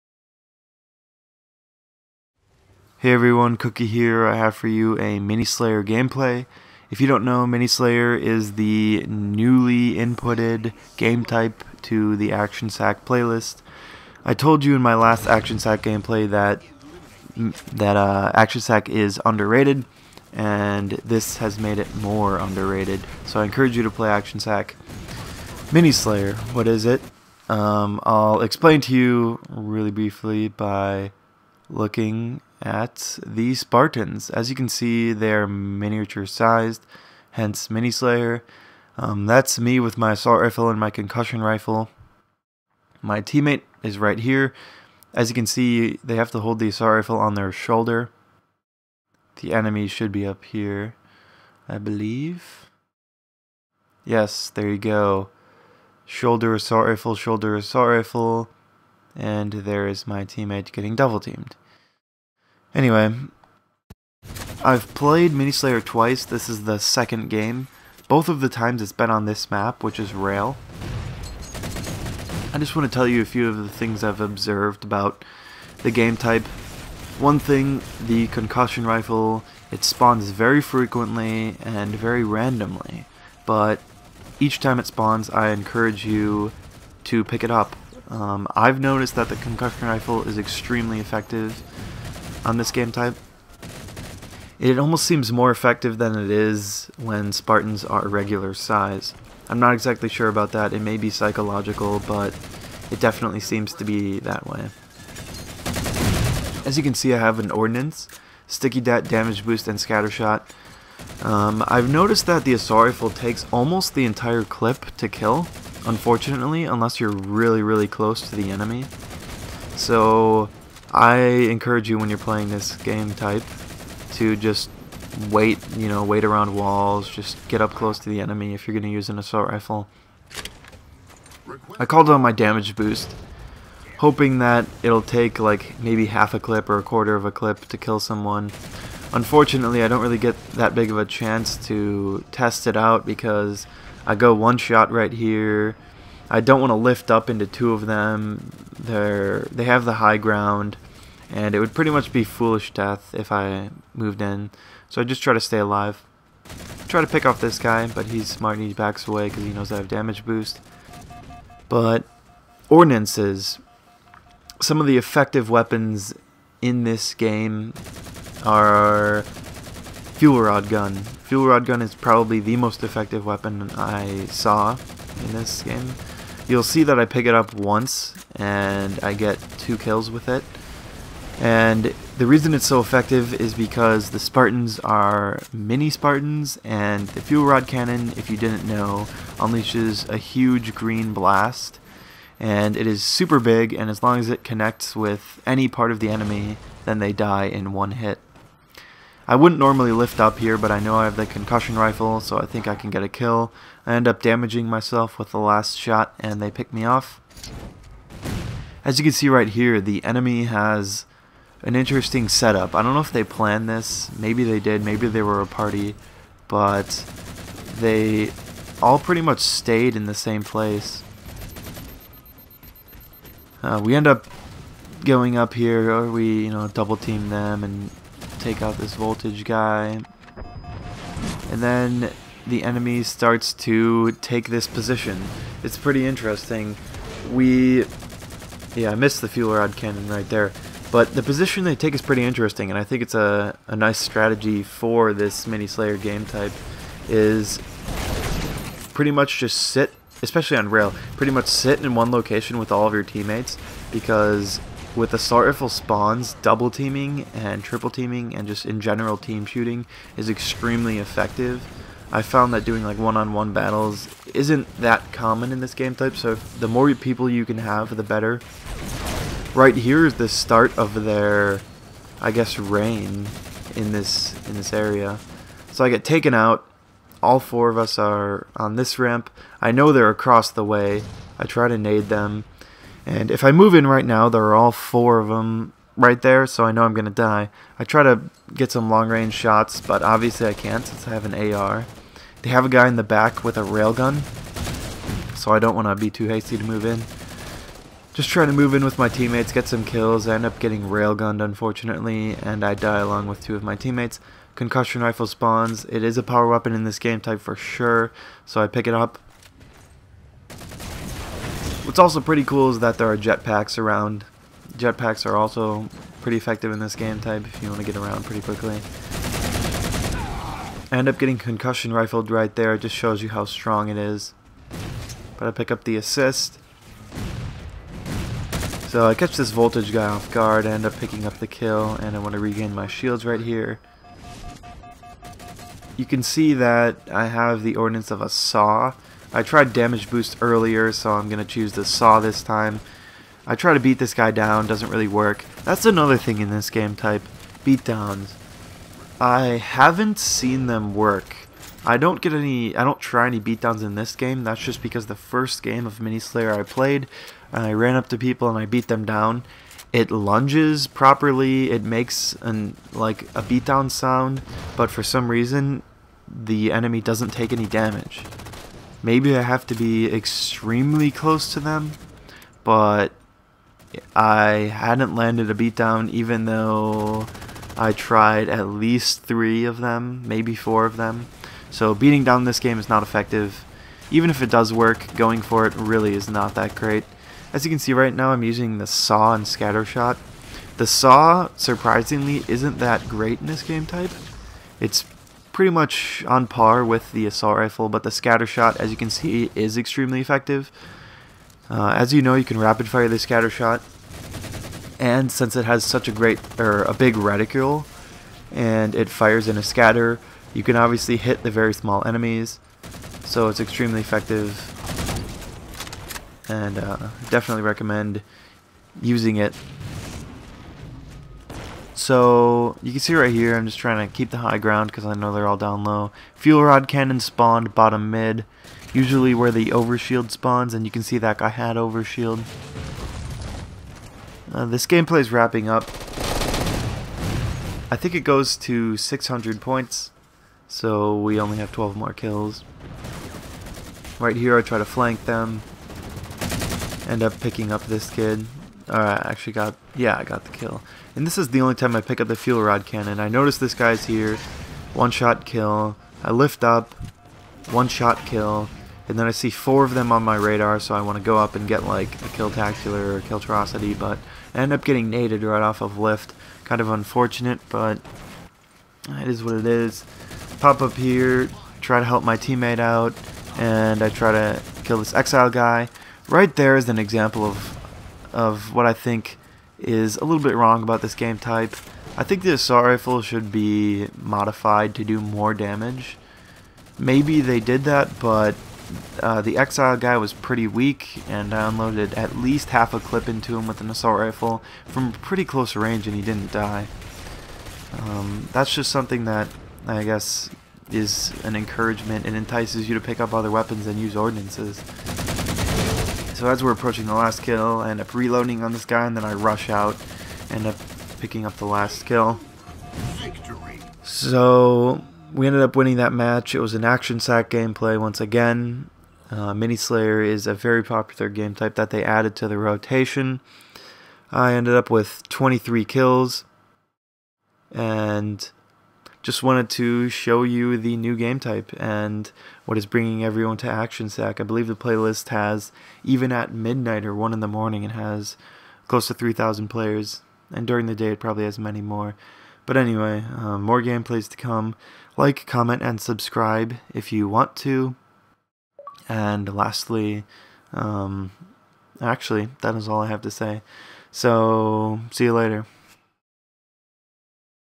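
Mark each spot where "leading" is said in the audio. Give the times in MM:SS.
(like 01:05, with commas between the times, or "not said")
not said.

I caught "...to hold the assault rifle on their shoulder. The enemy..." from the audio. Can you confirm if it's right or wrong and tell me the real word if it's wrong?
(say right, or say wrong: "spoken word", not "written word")
right.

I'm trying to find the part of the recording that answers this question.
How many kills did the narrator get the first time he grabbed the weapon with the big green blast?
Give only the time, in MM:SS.
02:59.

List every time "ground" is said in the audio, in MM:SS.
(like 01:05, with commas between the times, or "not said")
02:30, 07:04.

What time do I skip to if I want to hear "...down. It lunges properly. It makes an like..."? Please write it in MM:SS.
05:59.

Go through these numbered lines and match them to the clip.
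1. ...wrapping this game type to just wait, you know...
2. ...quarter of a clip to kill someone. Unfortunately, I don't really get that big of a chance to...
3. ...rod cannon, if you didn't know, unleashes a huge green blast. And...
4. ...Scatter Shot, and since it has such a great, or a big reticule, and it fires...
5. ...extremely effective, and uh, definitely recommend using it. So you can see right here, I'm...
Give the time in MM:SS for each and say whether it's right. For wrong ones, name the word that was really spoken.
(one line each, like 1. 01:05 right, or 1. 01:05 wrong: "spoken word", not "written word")
1. 02:02 wrong: "playing", not "wrapping"
2. 02:16 right
3. 03:07 right
4. 06:43 right
5. 06:53 right.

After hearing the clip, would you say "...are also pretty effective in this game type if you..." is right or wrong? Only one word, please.
right.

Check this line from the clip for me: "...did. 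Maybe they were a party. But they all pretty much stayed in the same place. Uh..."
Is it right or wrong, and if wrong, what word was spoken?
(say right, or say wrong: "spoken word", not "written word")
right.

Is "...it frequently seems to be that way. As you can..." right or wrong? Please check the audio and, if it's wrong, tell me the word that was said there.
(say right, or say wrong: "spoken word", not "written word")
wrong: "definitely", not "frequently".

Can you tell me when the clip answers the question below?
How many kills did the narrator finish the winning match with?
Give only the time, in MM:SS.
08:45.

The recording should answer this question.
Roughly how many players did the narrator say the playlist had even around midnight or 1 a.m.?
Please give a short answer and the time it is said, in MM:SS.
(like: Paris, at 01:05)
3,000, at 08:59.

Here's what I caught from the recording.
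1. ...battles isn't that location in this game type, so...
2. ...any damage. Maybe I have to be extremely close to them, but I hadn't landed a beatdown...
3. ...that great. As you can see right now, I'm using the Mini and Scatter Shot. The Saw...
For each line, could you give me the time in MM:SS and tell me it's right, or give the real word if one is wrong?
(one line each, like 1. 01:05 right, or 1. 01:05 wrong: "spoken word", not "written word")
1. 04:23 wrong: "common", not "location"
2. 06:07 right
3. 06:26 wrong: "Saw", not "Mini".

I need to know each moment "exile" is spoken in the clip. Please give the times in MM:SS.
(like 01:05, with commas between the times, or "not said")
07:55, 08:09.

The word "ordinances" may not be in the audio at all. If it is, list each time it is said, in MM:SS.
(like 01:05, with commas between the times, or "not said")
02:42, 05:37, 08:24.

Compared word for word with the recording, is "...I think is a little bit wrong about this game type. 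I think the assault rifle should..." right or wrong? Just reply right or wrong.
right.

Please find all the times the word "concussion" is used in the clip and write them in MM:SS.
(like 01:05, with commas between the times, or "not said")
00:40, 01:18, 01:29, 03:21, 05:04, 05:21.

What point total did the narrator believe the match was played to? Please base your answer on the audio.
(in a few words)
600.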